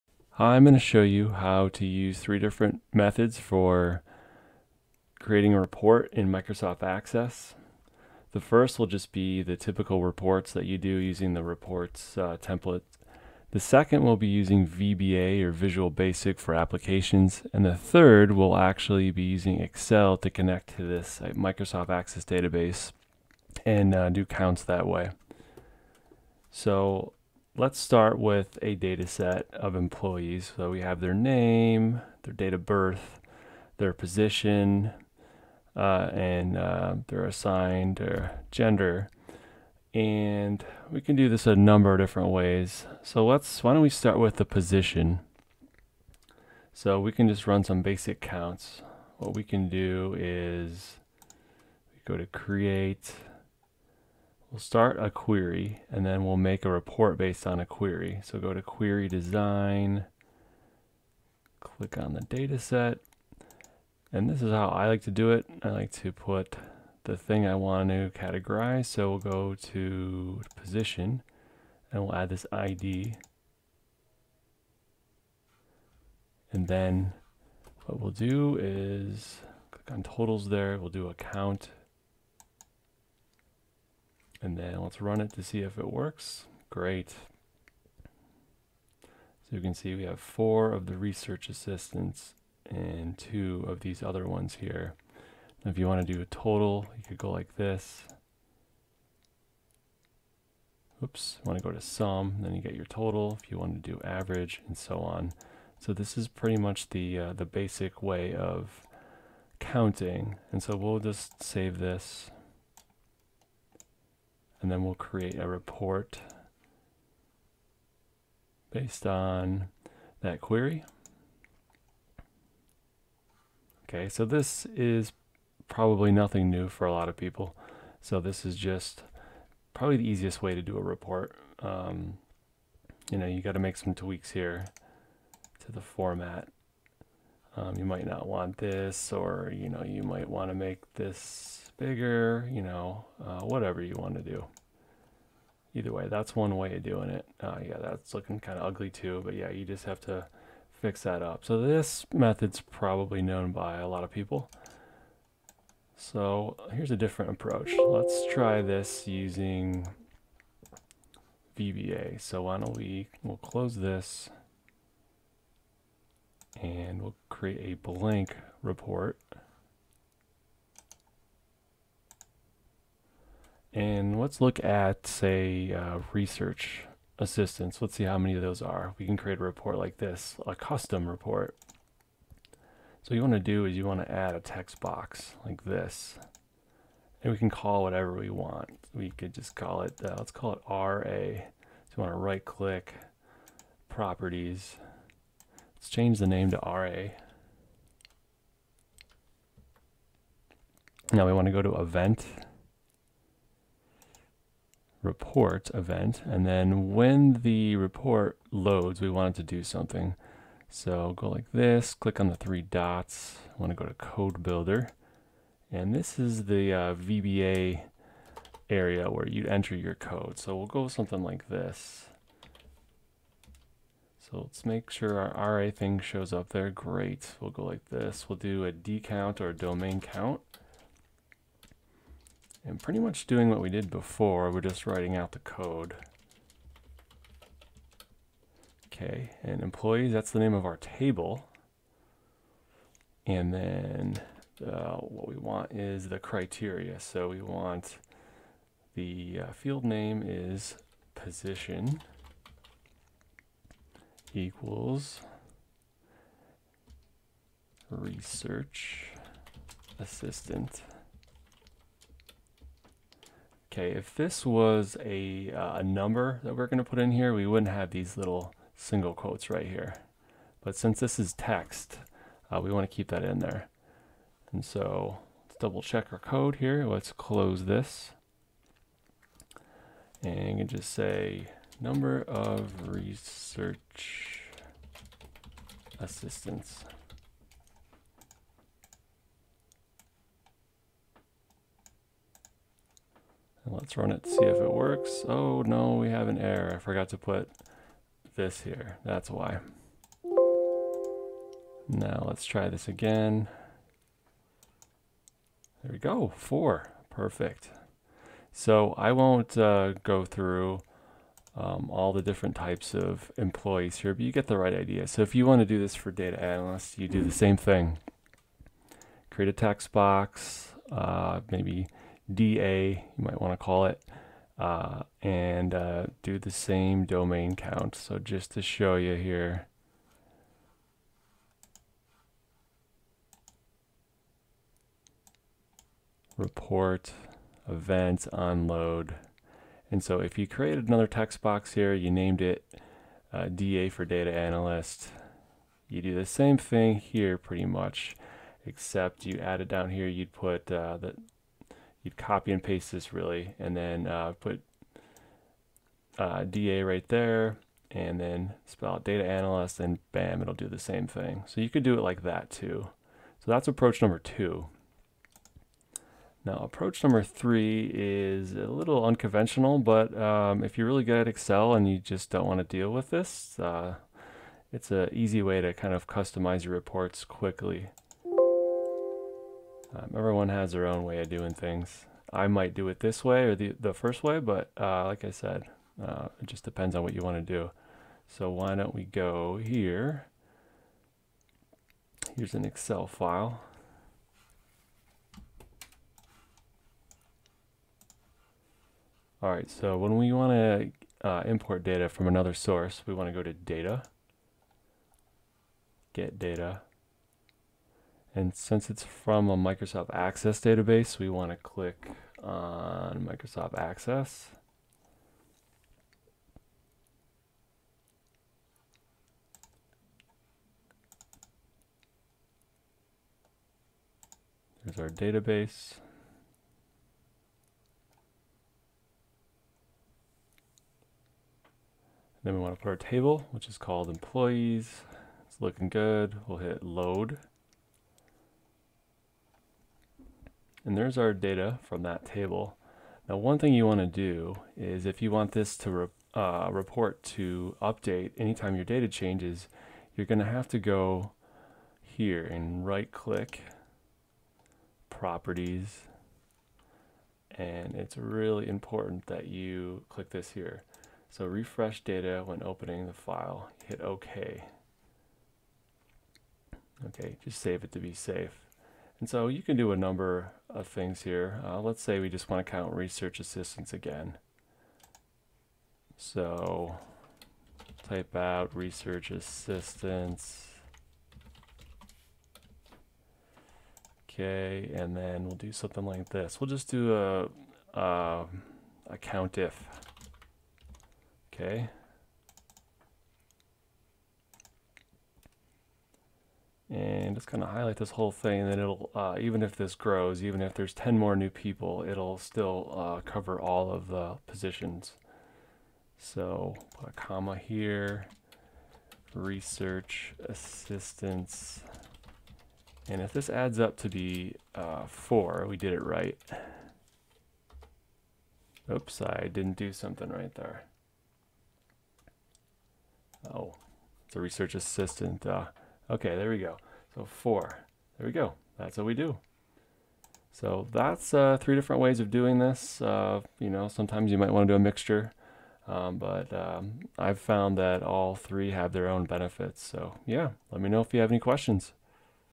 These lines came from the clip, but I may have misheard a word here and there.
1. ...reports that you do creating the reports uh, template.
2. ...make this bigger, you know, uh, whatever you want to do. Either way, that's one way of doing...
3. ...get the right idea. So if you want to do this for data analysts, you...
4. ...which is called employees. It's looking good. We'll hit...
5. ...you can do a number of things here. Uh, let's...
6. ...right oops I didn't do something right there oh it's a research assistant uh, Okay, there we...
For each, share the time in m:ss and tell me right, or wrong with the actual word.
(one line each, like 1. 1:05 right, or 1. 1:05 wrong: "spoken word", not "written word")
1. 0:10 wrong: "using", not "creating"
2. 2:20 right
3. 5:14 right
4. 7:13 right
5. 7:49 right
6. 8:36 right.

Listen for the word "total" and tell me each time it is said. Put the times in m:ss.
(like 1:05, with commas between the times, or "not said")
1:20, 1:36, 1:42.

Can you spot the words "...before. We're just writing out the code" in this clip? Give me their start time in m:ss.
3:53.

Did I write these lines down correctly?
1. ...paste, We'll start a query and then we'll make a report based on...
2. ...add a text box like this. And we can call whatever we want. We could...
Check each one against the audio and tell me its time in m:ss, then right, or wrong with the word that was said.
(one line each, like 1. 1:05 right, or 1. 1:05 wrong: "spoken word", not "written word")
1. 0:52 wrong: "create", not "paste"
2. 3:04 right.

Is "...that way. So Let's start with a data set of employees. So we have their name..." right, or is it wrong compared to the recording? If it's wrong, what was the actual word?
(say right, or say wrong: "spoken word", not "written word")
right.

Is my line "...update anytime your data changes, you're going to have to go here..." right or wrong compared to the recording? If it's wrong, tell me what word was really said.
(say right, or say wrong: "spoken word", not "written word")
right.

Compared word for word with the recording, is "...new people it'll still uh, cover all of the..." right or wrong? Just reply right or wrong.
right.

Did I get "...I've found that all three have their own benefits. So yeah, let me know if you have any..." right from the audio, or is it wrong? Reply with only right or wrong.
right.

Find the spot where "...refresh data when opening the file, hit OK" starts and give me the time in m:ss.
7:41.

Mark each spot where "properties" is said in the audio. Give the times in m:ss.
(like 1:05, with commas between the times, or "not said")
3:13, 7:35.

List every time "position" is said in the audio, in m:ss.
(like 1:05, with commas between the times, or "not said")
0:33, 0:44, 1:10, 4:11, 8:24.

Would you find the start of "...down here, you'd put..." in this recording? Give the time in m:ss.
5:49.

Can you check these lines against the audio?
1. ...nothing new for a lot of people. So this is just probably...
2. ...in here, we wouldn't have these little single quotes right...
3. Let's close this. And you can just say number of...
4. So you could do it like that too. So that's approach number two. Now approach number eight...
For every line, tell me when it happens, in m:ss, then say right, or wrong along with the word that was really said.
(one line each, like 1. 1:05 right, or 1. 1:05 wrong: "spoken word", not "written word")
1. 2:06 right
2. 4:26 right
3. 4:36 right
4. 6:01 wrong: "three", not "eight".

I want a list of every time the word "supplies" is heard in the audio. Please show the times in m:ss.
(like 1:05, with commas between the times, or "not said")
not said.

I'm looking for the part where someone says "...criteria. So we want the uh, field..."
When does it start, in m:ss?
4:06.